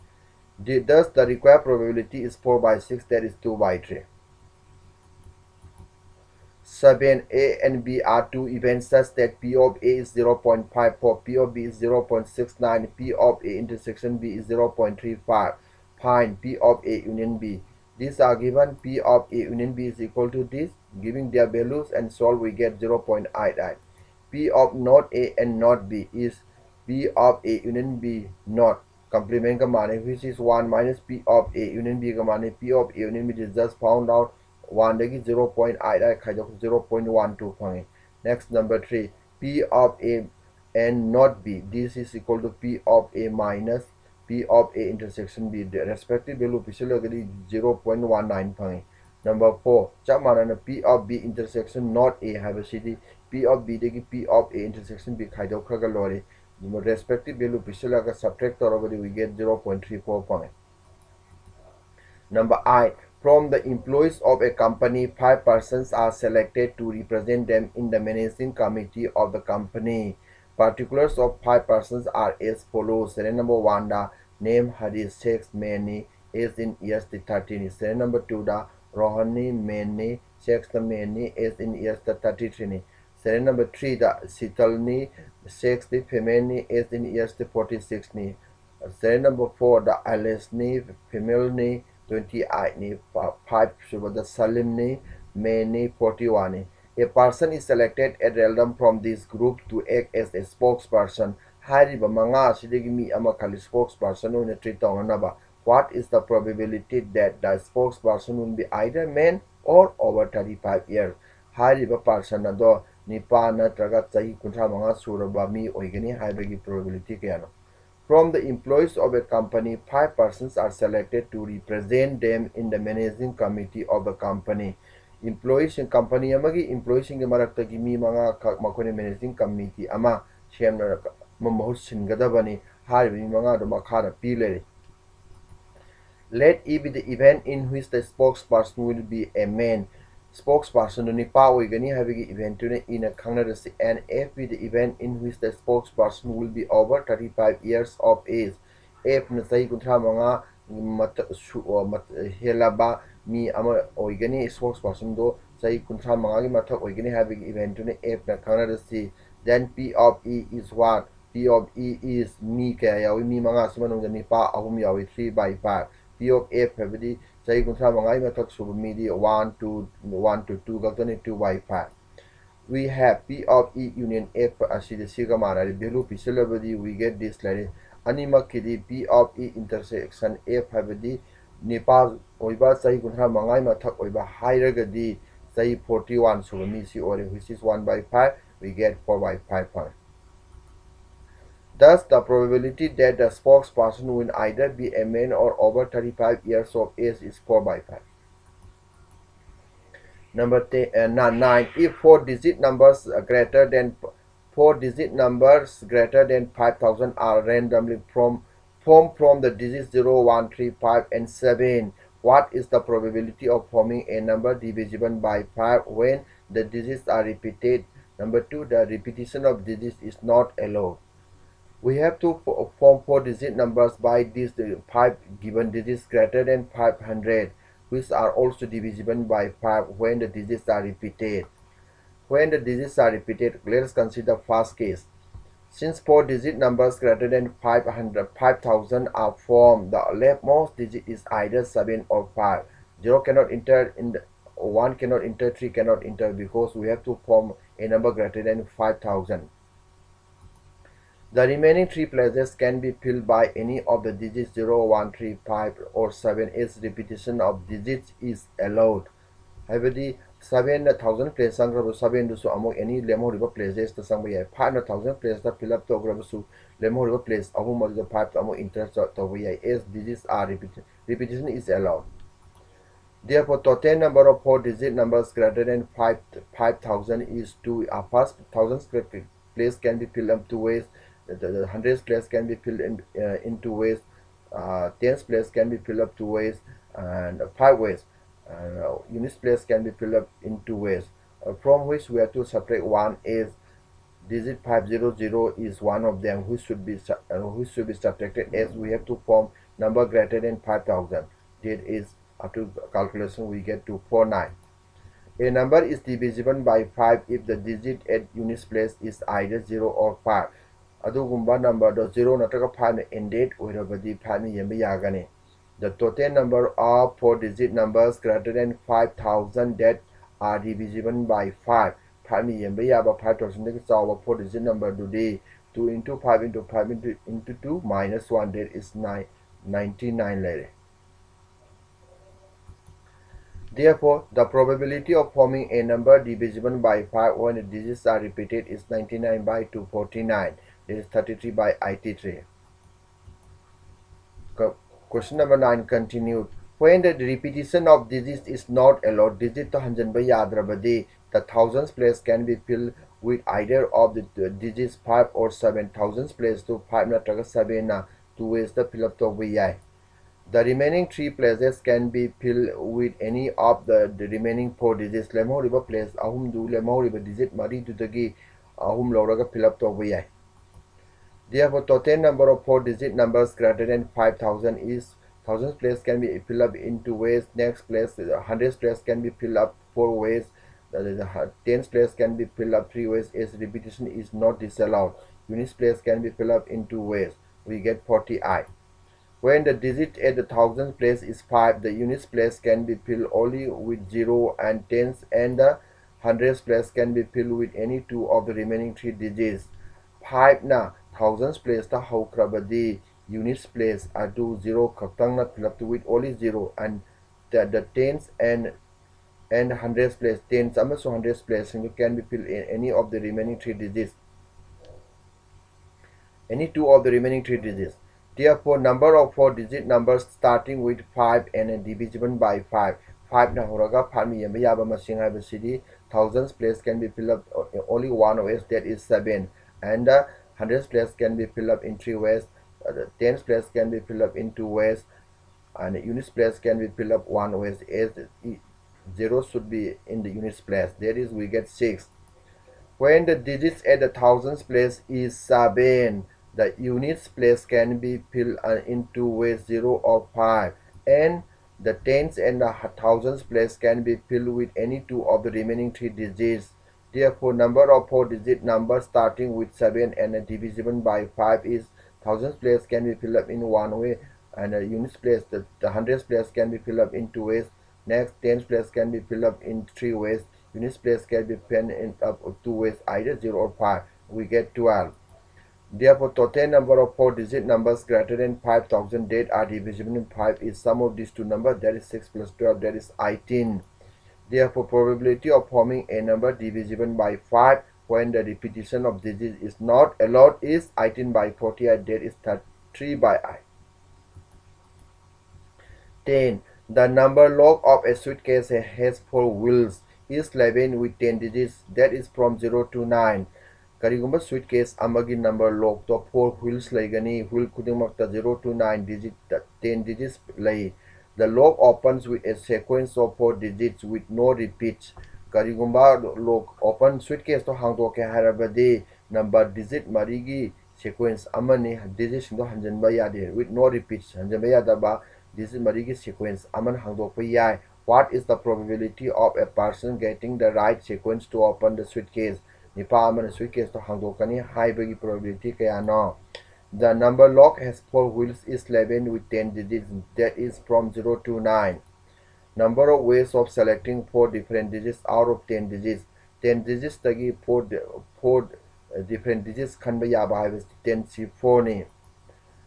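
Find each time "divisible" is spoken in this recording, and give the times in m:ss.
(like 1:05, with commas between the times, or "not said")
3:34, 3:48, 5:05, 5:36, 7:01, 7:40, 7:59, 8:06.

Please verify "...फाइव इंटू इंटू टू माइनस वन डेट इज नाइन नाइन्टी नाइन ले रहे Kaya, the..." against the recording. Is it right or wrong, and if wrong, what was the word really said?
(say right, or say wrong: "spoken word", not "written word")
wrong: "Therefore", not "Kaya".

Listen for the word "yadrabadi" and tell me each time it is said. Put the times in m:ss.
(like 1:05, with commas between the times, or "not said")
5:50.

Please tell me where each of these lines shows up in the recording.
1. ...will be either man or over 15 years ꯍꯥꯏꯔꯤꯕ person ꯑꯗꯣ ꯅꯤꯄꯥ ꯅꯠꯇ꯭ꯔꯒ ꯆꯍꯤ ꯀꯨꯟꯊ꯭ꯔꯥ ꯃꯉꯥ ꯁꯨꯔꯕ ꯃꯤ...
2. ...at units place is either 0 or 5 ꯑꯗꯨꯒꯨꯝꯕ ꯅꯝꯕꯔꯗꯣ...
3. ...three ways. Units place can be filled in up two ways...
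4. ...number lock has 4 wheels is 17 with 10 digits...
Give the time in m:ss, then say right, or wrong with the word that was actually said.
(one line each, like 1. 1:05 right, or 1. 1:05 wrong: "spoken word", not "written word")
1. 1:48 wrong: "35", not "15"
2. 5:08 right
3. 7:49 right
4. 8:57 wrong: "11", not "17".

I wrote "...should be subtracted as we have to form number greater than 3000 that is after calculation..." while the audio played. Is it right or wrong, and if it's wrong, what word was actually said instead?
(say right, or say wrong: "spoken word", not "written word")
wrong: "5000", not "3000".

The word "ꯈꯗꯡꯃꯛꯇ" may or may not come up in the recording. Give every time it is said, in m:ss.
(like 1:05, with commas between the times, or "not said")
8:28.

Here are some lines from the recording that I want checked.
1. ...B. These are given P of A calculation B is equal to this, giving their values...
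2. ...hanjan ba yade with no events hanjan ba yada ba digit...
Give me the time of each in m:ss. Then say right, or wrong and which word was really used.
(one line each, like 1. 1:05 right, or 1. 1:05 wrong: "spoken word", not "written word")
1. 0:17 wrong: "union", not "calculation"
2. 8:42 wrong: "repeats", not "events".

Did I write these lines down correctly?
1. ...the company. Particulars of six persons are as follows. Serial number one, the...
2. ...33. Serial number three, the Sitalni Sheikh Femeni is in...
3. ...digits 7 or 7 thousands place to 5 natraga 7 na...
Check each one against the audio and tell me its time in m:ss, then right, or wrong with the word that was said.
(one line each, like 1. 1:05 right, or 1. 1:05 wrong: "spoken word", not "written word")
1. 1:09 wrong: "five", not "six"
2. 1:22 right
3. 5:54 wrong: "5", not "7".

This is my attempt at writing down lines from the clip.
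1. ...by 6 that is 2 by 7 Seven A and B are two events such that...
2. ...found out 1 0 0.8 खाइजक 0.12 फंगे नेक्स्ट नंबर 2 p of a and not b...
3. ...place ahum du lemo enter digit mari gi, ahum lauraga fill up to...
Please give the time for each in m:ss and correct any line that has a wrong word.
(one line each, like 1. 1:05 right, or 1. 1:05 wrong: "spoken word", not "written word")
1. 0:02 wrong: "3", not "7"
2. 0:33 wrong: "3", not "2"
3. 6:05 wrong: "river", not "enter".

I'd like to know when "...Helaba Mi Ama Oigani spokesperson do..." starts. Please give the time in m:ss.
2:31.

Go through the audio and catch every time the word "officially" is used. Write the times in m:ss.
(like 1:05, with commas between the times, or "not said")
0:46, 0:57.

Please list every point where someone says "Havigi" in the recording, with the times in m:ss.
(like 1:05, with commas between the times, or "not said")
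2:21, 2:37, 2:46.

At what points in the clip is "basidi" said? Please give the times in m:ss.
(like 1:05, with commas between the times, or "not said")
7:05.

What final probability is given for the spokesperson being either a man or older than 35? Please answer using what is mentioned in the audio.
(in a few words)
4/5.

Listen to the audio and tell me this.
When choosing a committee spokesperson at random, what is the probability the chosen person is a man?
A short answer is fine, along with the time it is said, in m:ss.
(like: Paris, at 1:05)
3/5, at 2:45.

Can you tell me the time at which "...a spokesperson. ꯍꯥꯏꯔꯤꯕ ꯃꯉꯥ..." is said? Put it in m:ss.
1:40.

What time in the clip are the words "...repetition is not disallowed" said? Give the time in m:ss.
6:23.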